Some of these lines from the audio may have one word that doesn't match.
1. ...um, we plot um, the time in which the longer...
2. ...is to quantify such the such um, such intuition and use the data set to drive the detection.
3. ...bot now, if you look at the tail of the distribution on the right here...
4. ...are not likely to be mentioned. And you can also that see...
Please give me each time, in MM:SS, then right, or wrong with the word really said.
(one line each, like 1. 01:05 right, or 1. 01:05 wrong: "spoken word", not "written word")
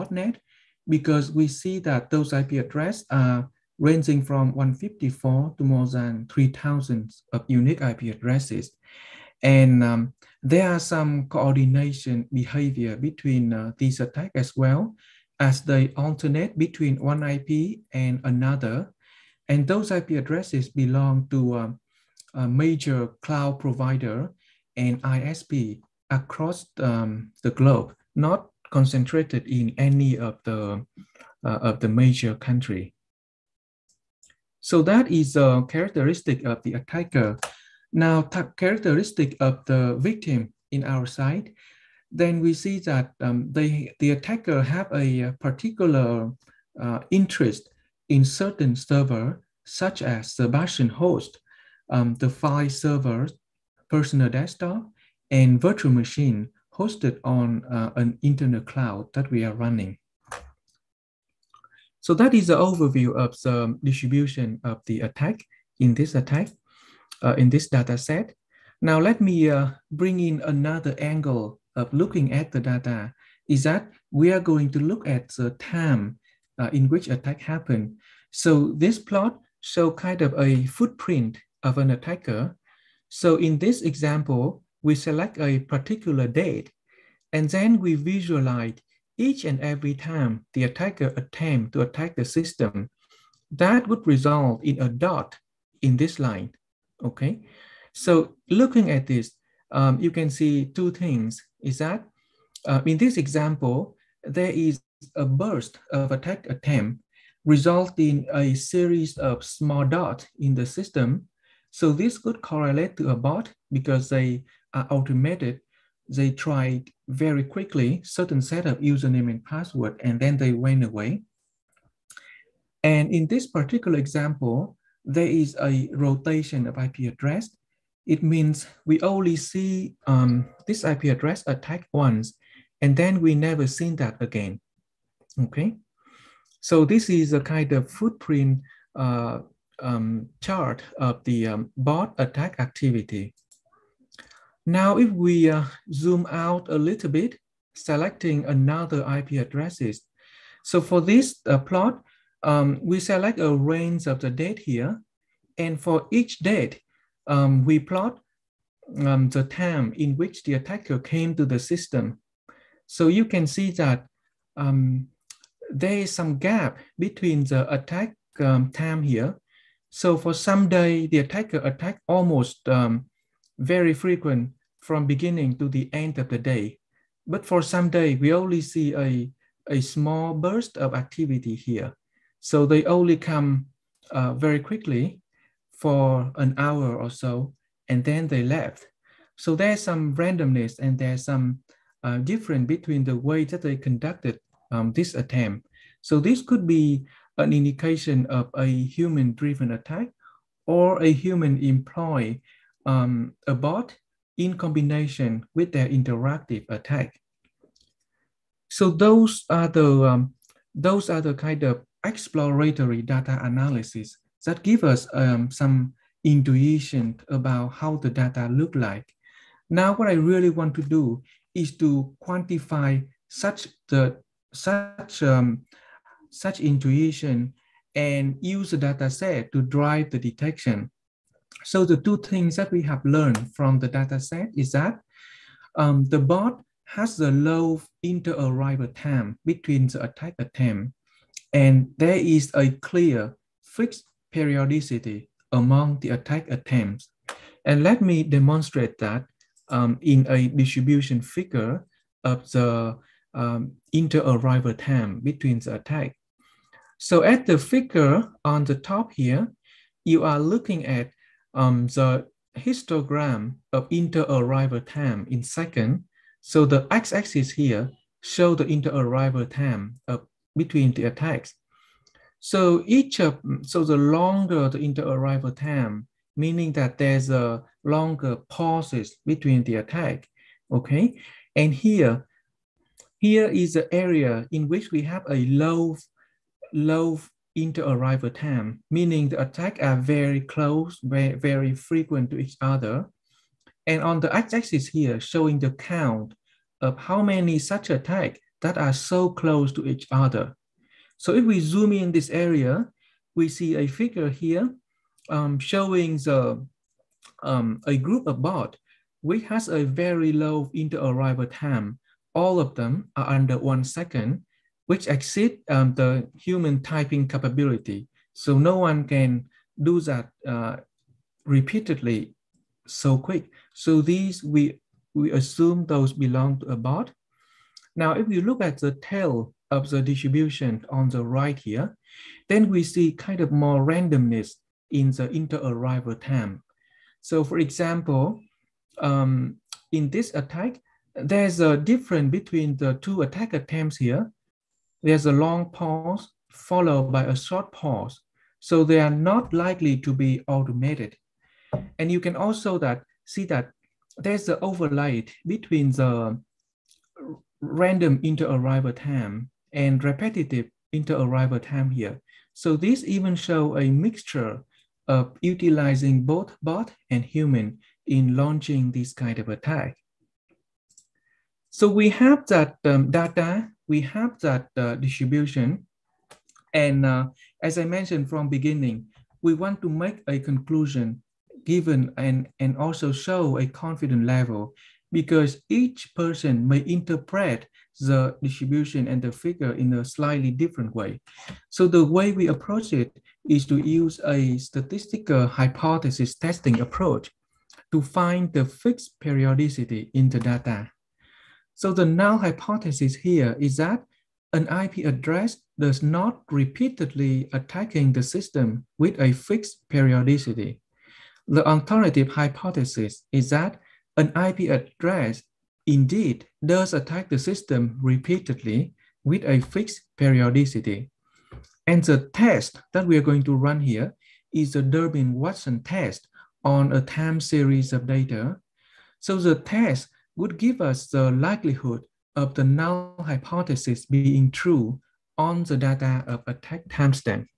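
1. 02:37 wrong: "attacker", not "longer"
2. 03:41 right
3. 05:26 right
4. 05:49 wrong: "automated", not "mentioned".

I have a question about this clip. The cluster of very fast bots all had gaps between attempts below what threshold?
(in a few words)
one second.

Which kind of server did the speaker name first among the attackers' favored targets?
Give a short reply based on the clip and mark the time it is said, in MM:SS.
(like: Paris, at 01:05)
bastion host, at 00:50.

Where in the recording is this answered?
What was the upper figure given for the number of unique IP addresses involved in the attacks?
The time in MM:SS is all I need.
00:06.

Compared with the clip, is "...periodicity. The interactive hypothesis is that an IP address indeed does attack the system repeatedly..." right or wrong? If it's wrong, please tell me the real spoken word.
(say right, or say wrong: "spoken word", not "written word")
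wrong: "alternative", not "interactive".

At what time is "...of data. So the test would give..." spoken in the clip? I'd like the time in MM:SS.
07:07.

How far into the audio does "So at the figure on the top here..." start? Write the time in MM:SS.
04:16.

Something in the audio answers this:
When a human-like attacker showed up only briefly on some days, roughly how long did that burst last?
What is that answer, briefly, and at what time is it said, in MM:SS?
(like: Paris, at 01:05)
an hour, at 03:06.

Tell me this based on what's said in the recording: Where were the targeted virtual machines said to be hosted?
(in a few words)
an internal cloud.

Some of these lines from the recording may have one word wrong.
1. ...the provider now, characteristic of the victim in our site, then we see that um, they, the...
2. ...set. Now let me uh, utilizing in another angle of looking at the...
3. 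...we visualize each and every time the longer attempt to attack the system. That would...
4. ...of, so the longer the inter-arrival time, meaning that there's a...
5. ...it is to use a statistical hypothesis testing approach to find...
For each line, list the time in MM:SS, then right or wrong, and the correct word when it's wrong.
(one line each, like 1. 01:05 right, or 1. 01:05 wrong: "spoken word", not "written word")
1. 00:36 wrong: "attacker", not "provider"
2. 01:07 wrong: "bring", not "utilizing"
3. 01:27 wrong: "attacker", not "longer"
4. 04:33 right
5. 06:32 right.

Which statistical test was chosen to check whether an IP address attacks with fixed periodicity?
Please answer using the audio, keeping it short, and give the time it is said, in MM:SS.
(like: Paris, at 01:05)
Durbin-Watson test, at 07:04.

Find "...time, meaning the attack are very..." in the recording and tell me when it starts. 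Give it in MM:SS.
04:48.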